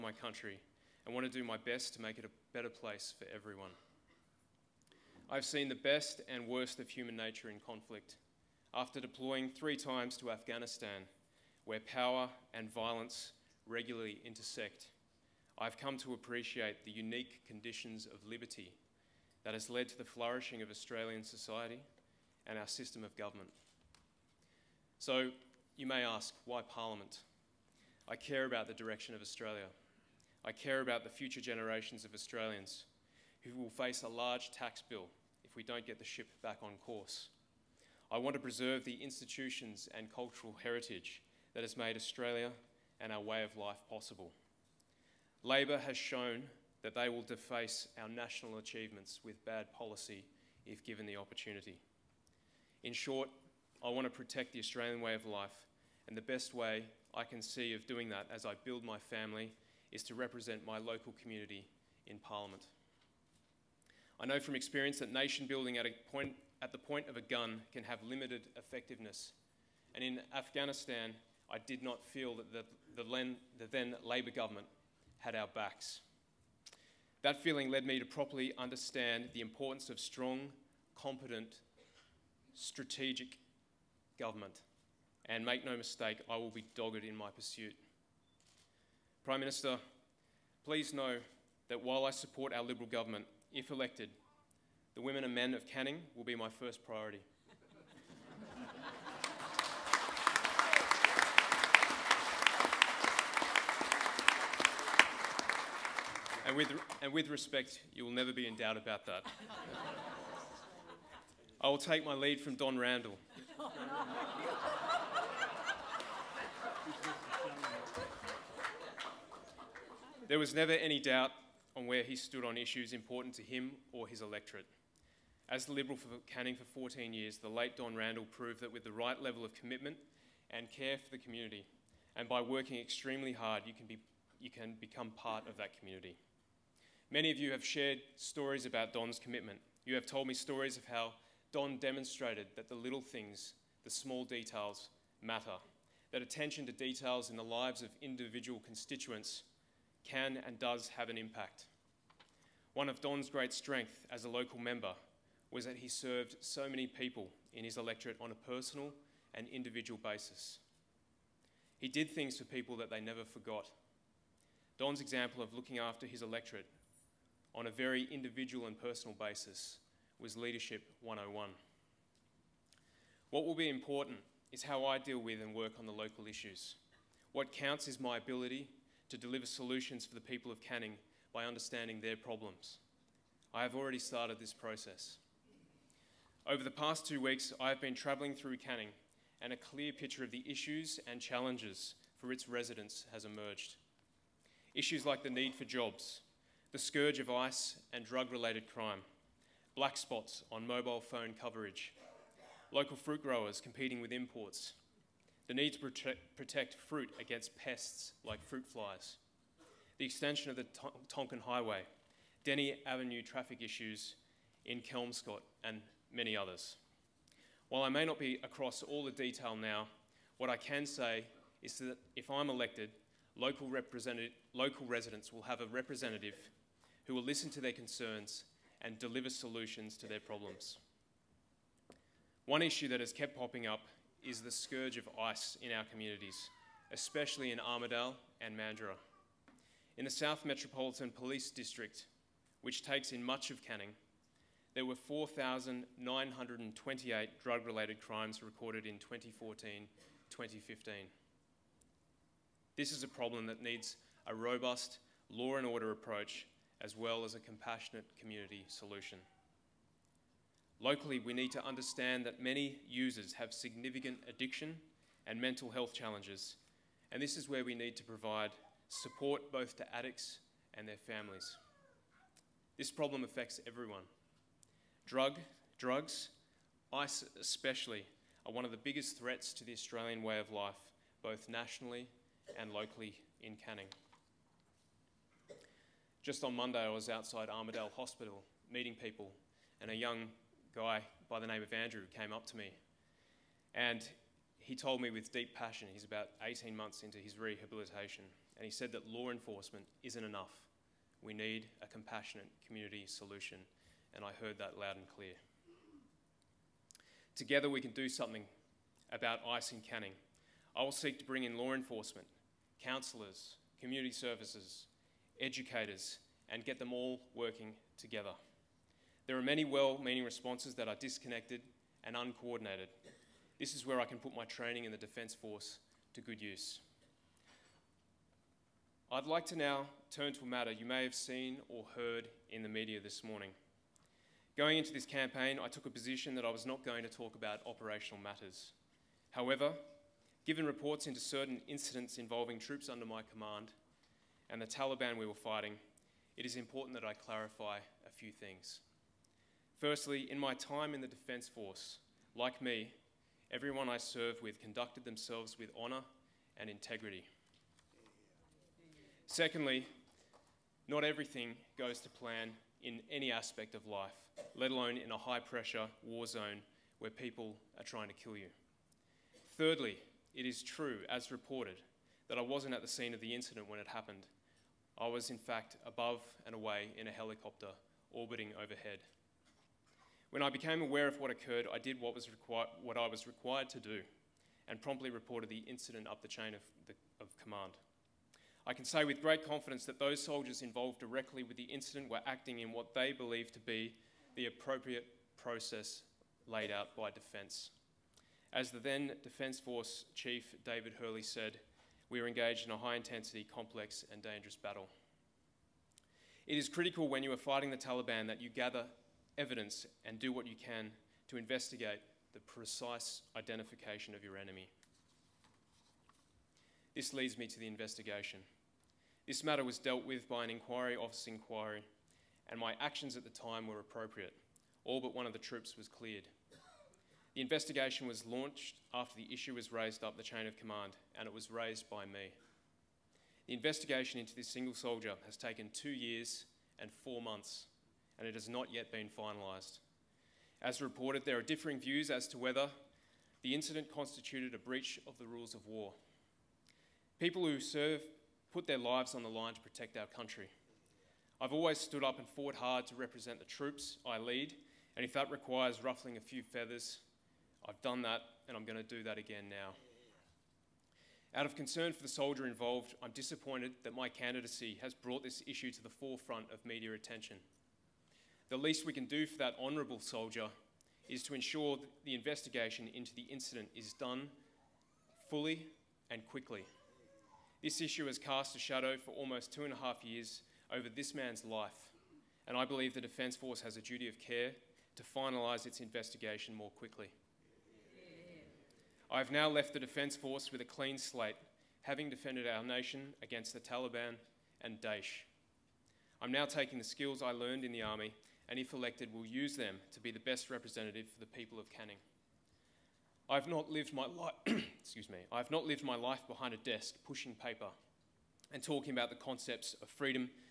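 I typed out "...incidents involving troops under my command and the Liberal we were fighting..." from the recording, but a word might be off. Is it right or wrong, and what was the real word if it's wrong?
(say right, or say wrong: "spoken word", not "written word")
wrong: "Taliban", not "Liberal".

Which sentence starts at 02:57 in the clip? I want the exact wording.
What counts is my ability to deliver solutions for the people of Canning by understanding their problems.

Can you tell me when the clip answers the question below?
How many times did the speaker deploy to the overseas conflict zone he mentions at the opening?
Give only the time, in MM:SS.
00:09.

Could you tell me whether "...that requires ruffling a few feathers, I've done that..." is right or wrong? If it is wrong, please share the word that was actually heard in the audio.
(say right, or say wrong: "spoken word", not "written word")
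right.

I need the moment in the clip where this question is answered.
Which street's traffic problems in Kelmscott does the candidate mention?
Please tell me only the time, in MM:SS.
03:32.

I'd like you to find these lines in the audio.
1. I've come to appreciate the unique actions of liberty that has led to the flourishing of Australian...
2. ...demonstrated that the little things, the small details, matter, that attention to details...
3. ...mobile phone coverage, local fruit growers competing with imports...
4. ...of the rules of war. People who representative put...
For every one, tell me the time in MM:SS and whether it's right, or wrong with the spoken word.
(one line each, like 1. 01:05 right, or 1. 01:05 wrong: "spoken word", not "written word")
1. 00:15 wrong: "conditions", not "actions"
2. 02:21 right
3. 03:20 right
4. 07:25 wrong: "serve", not "representative".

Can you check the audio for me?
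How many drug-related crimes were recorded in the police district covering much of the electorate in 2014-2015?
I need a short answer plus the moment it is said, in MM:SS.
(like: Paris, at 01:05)
4,928, at 04:04.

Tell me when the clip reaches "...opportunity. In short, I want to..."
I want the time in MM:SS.
00:51.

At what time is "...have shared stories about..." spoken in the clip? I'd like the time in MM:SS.
02:17.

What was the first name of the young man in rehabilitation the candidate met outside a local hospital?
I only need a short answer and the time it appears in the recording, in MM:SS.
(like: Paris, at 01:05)
Andrew, at 04:51.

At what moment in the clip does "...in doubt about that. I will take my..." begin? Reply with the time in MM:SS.
01:48.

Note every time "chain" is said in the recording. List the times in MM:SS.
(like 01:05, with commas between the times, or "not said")
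06:26, 07:10.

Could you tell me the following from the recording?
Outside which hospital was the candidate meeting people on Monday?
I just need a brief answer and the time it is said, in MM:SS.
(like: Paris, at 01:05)
Armadale Hospital, at 04:47.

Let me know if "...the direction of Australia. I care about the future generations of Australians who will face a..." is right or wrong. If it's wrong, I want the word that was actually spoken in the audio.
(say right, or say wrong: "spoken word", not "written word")
right.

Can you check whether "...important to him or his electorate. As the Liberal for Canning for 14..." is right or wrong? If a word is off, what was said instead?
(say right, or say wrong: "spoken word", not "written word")
right.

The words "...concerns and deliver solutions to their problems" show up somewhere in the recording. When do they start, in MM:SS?
03:47.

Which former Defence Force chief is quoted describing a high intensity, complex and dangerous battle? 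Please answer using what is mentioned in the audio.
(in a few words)
David Hurley.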